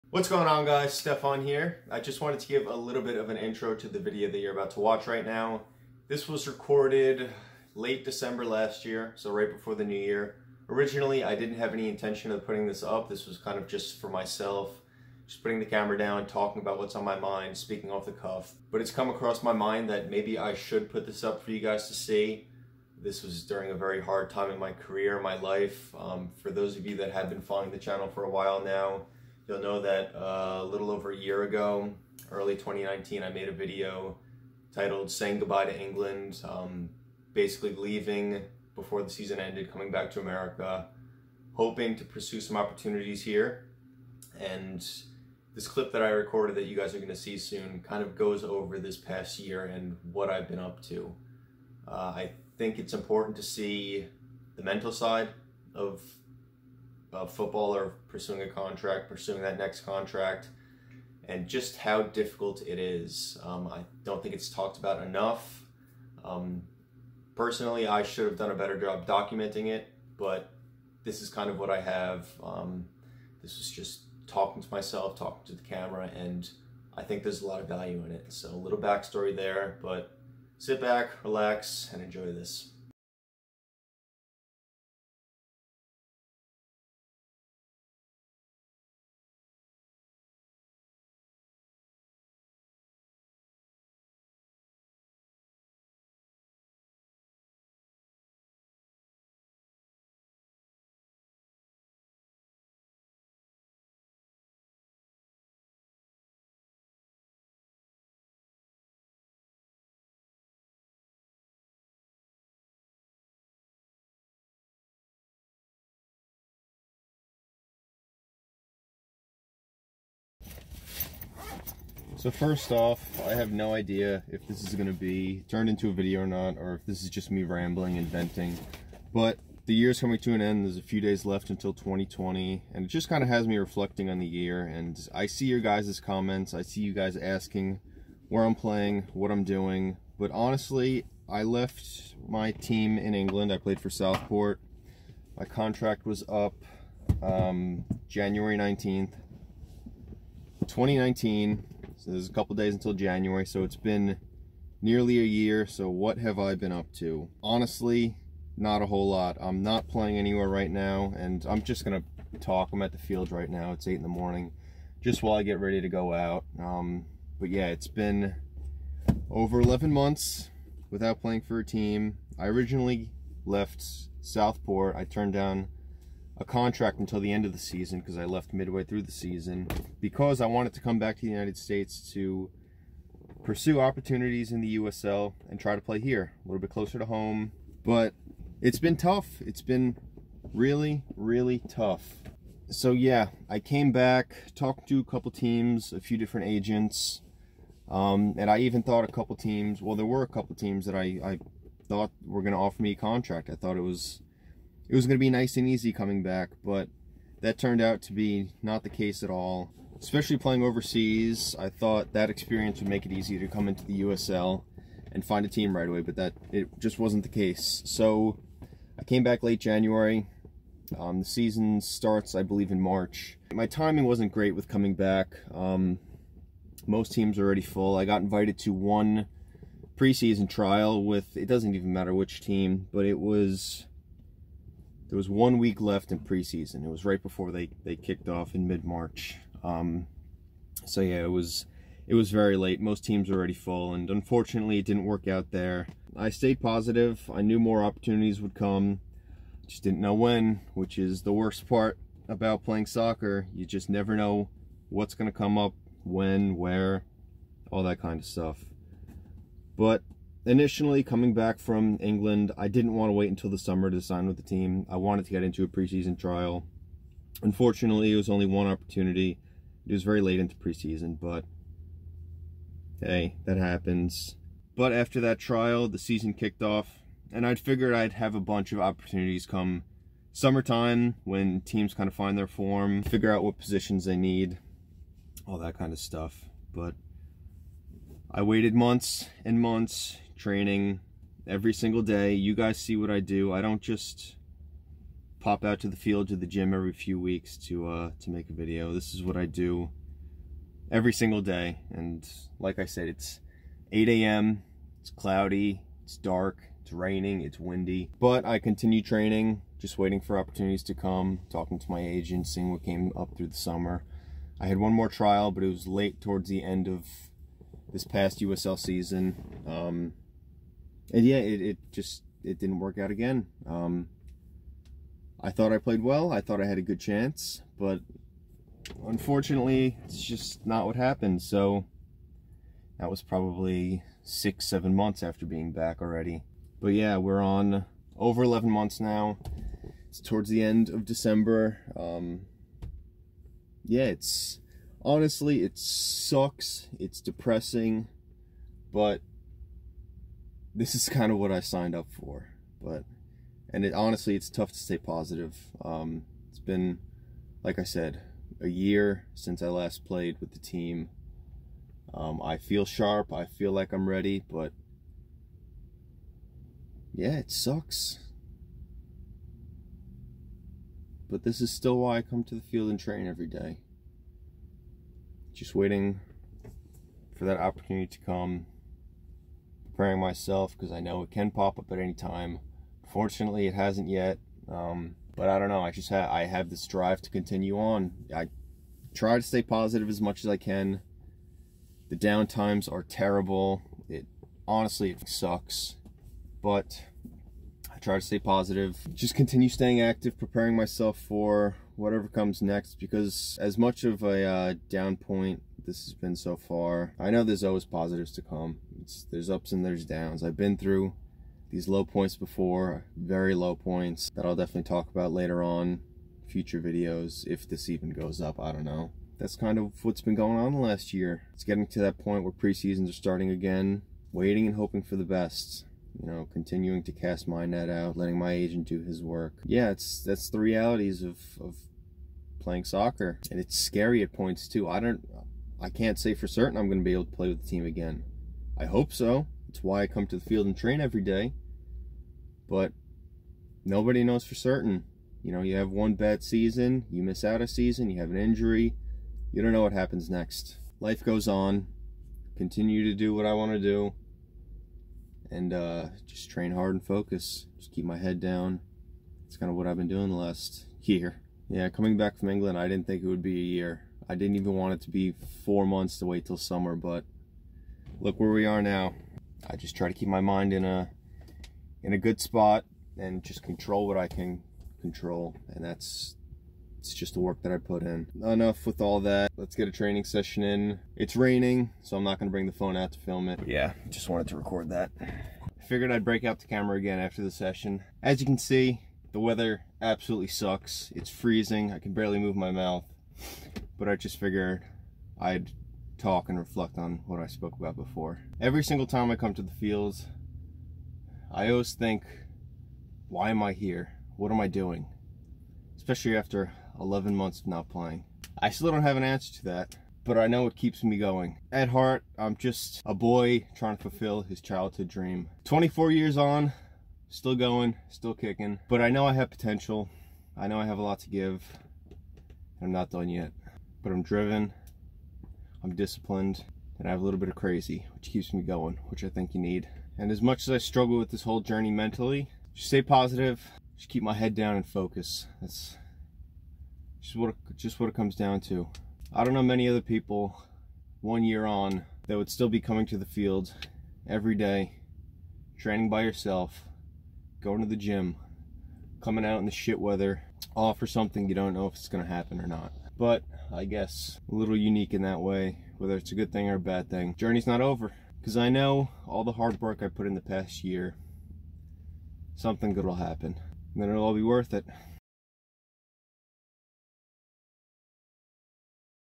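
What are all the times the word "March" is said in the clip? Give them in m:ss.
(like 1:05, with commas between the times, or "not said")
3:42, 3:58.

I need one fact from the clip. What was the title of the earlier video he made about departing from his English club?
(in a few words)
Saying Goodbye to England.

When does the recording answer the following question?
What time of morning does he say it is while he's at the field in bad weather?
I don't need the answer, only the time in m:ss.
5:03.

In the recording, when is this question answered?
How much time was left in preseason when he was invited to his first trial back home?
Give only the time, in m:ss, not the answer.
3:55.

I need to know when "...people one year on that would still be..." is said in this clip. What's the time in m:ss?
9:00.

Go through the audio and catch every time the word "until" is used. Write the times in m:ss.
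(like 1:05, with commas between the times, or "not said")
2:11, 2:32, 2:56, 4:23.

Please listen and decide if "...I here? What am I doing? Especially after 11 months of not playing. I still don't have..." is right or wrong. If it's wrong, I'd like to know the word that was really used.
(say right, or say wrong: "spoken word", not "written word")
right.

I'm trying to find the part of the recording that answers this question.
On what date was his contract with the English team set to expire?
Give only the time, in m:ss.
2:28.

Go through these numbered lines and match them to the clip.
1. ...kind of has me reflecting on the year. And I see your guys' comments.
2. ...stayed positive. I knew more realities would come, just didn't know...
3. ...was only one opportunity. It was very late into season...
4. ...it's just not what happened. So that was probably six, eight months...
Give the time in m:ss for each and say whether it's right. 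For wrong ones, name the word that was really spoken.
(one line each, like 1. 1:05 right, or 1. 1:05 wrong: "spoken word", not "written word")
1. 2:13 right
2. 4:06 wrong: "opportunities", not "realities"
3. 4:28 wrong: "preseason", not "season"
4. 5:30 wrong: "seven", not "eight".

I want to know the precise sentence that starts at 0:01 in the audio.
I just wanted to give a little bit of an intro to the video that you're about to watch right now.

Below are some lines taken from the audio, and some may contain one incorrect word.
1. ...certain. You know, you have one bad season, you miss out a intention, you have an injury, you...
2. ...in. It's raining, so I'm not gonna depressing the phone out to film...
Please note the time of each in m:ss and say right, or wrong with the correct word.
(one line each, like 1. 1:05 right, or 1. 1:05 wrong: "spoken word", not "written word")
1. 7:24 wrong: "season", not "intention"
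2. 8:00 wrong: "bring", not "depressing".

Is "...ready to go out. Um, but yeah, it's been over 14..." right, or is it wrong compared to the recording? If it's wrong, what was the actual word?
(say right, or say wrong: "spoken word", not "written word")
wrong: "11", not "14".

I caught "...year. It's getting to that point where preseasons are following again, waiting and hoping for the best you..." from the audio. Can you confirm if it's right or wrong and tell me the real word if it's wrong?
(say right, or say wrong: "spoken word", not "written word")
wrong: "starting", not "following".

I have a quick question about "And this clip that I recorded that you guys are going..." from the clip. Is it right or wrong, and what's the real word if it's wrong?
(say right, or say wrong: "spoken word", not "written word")
right.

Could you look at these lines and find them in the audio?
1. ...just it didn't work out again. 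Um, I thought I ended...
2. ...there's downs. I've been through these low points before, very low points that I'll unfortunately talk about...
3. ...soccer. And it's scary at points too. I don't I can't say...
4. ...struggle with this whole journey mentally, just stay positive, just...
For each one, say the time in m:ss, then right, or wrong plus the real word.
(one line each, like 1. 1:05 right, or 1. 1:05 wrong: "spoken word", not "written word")
1. 5:21 wrong: "played", not "ended"
2. 6:49 wrong: "definitely", not "unfortunately"
3. 7:12 right
4. 8:50 right.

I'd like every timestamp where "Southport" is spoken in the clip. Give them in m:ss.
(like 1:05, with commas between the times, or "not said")
2:23, 2:54.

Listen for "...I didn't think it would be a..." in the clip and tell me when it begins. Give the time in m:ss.
7:42.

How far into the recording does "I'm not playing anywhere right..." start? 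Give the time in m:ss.
2:39.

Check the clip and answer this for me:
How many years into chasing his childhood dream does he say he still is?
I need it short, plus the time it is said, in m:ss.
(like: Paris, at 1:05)
24, at 8:35.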